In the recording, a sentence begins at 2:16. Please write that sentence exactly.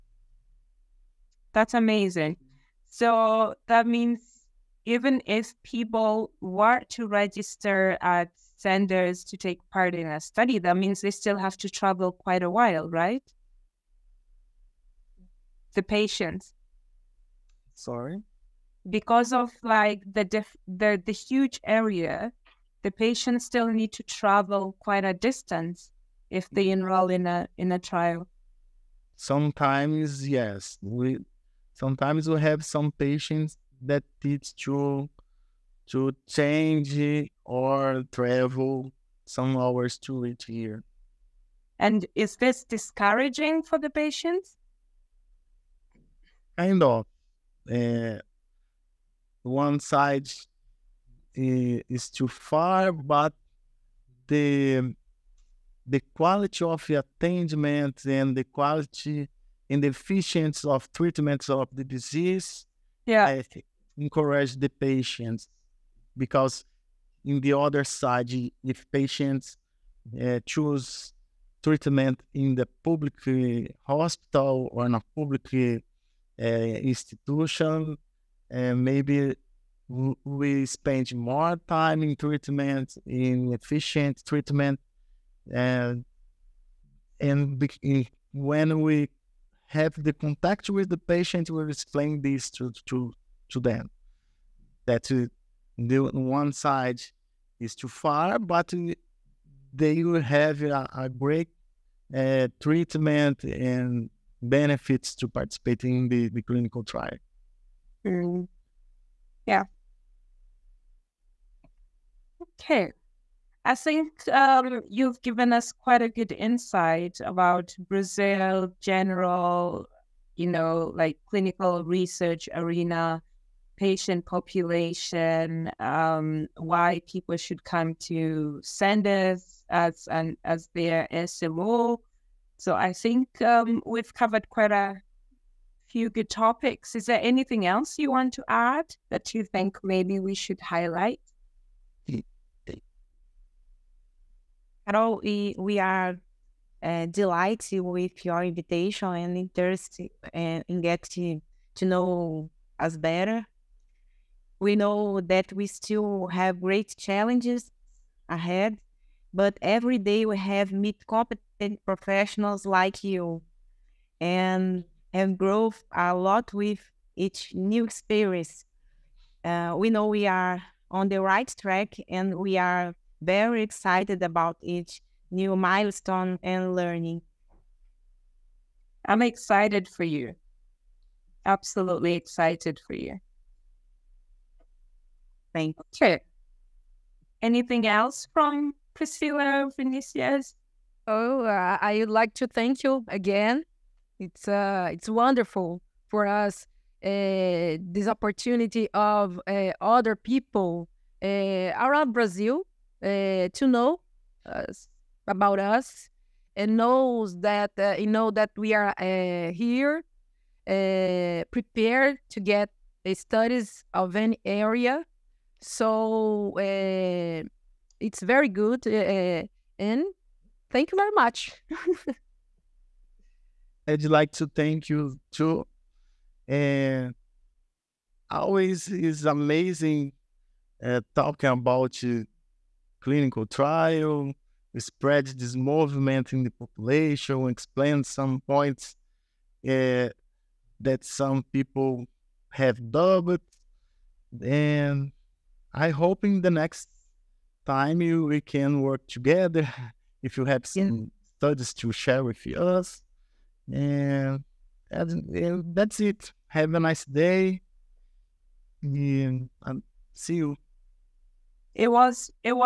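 Is there anything else you want to add that you think maybe we should highlight?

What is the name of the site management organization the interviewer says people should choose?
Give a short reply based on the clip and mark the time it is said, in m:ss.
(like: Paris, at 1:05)
Cenders, at 2:08.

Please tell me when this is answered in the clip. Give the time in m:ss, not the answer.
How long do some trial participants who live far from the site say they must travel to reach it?
0:39.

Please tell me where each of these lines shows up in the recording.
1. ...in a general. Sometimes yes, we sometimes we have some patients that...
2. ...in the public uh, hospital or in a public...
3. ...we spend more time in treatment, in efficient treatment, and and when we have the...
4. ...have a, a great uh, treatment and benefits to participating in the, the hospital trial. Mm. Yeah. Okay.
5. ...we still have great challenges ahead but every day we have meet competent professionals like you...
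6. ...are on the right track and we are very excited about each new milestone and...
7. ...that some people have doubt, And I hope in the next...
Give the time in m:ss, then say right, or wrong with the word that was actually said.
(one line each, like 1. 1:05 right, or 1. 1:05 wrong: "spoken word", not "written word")
1. 0:27 wrong: "trial", not "general"
2. 1:12 right
3. 1:19 right
4. 1:40 wrong: "clinical", not "hospital"
5. 2:35 right
6. 2:50 right
7. 4:00 right.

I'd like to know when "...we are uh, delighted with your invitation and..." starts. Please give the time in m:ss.
2:25.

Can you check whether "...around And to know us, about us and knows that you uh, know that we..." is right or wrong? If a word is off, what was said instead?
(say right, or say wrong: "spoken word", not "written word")
wrong: "Brazil", not "And".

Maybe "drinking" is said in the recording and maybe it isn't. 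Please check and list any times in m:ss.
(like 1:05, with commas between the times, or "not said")
not said.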